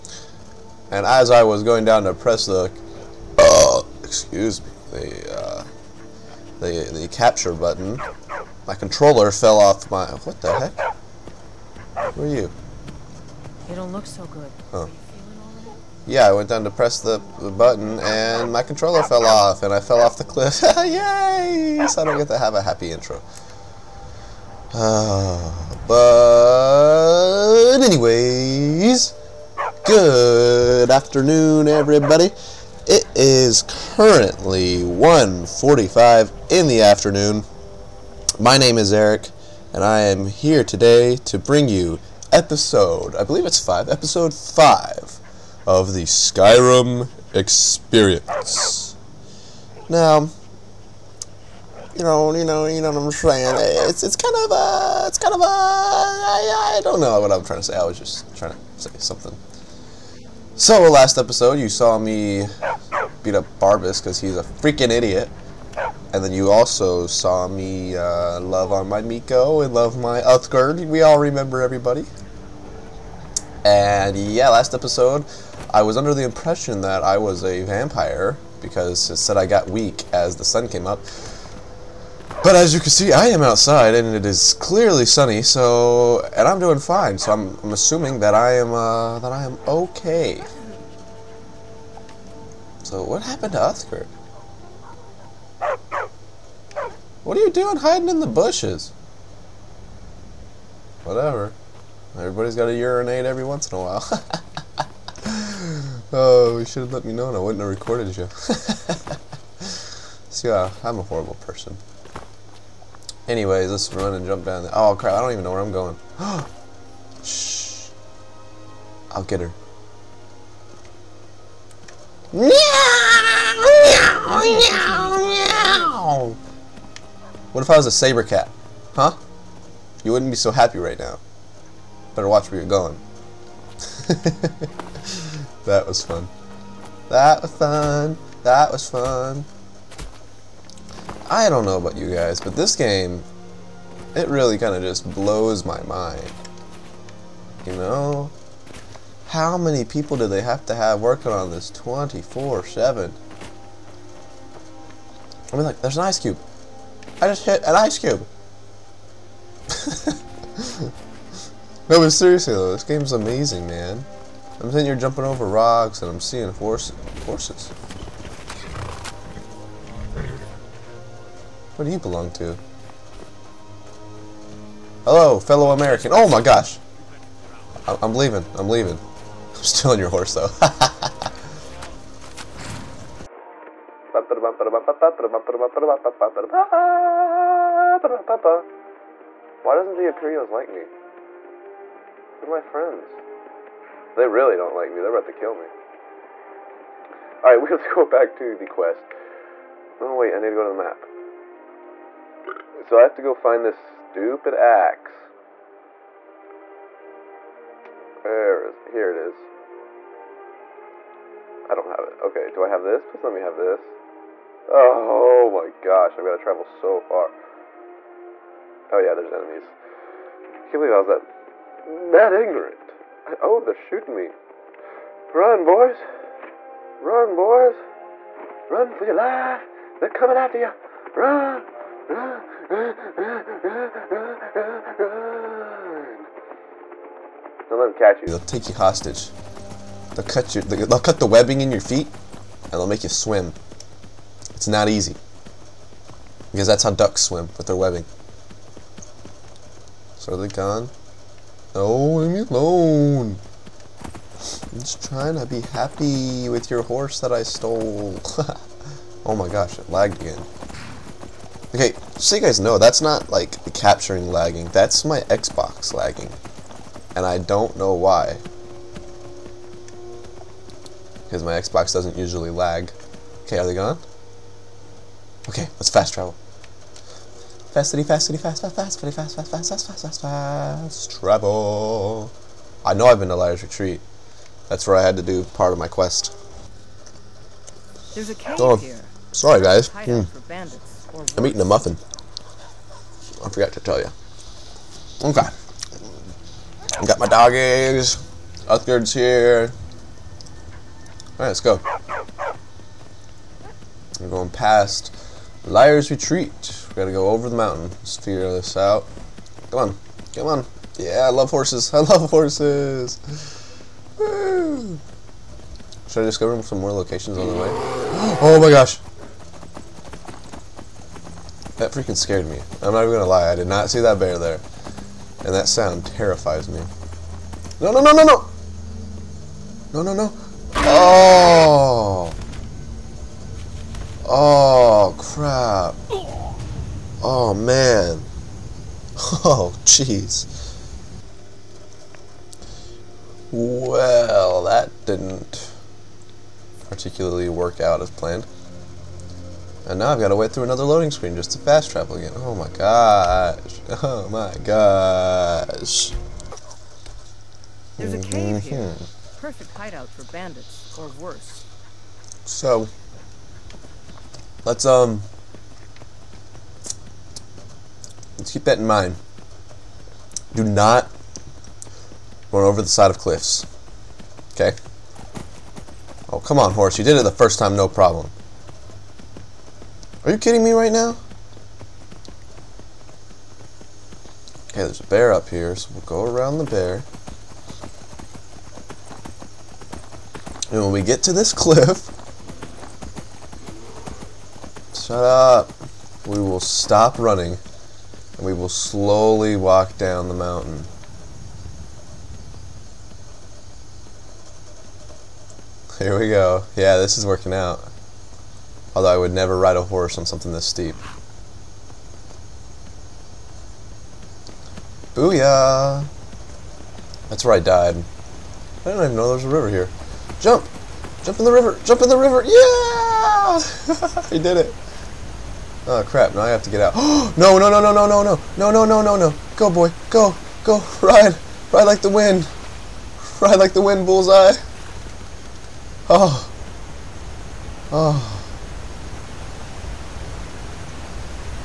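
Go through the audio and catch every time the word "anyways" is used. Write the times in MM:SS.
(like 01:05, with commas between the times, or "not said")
00:27, 01:53.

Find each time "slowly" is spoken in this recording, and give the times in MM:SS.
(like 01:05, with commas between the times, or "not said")
06:38.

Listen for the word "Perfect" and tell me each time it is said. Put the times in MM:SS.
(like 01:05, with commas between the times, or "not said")
05:59.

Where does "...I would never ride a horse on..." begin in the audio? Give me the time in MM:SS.
06:49.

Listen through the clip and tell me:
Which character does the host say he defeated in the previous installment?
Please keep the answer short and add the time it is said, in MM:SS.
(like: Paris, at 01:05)
Barbas, at 01:03.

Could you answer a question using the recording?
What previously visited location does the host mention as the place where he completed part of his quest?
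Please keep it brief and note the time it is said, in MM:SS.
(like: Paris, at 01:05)
Liar's Retreat, at 04:43.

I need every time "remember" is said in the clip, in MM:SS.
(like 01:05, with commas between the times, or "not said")
01:11.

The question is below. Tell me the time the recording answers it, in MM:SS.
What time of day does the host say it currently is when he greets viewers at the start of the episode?
00:34.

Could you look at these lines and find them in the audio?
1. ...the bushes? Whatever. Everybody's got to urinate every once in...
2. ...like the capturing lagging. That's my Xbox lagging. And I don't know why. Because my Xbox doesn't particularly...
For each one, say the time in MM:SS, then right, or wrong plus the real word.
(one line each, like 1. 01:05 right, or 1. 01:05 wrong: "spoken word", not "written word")
1. 01:38 right
2. 04:23 wrong: "usually", not "particularly".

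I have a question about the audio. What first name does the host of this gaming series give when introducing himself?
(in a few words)
Eric.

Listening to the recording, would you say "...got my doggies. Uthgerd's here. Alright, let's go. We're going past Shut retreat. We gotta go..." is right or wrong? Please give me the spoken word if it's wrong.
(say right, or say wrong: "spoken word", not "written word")
wrong: "Liars", not "Shut".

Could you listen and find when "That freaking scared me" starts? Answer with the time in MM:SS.
05:21.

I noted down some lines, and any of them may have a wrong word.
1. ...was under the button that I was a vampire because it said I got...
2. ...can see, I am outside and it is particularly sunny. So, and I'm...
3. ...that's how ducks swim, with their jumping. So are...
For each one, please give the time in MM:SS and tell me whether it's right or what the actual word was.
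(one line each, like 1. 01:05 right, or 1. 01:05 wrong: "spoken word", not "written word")
1. 01:15 wrong: "impression", not "button"
2. 01:22 wrong: "clearly", not "particularly"
3. 04:06 wrong: "webbing", not "jumping".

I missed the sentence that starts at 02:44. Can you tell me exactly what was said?
I'm sitting here jumping over rocks and I'm seeing horse horses.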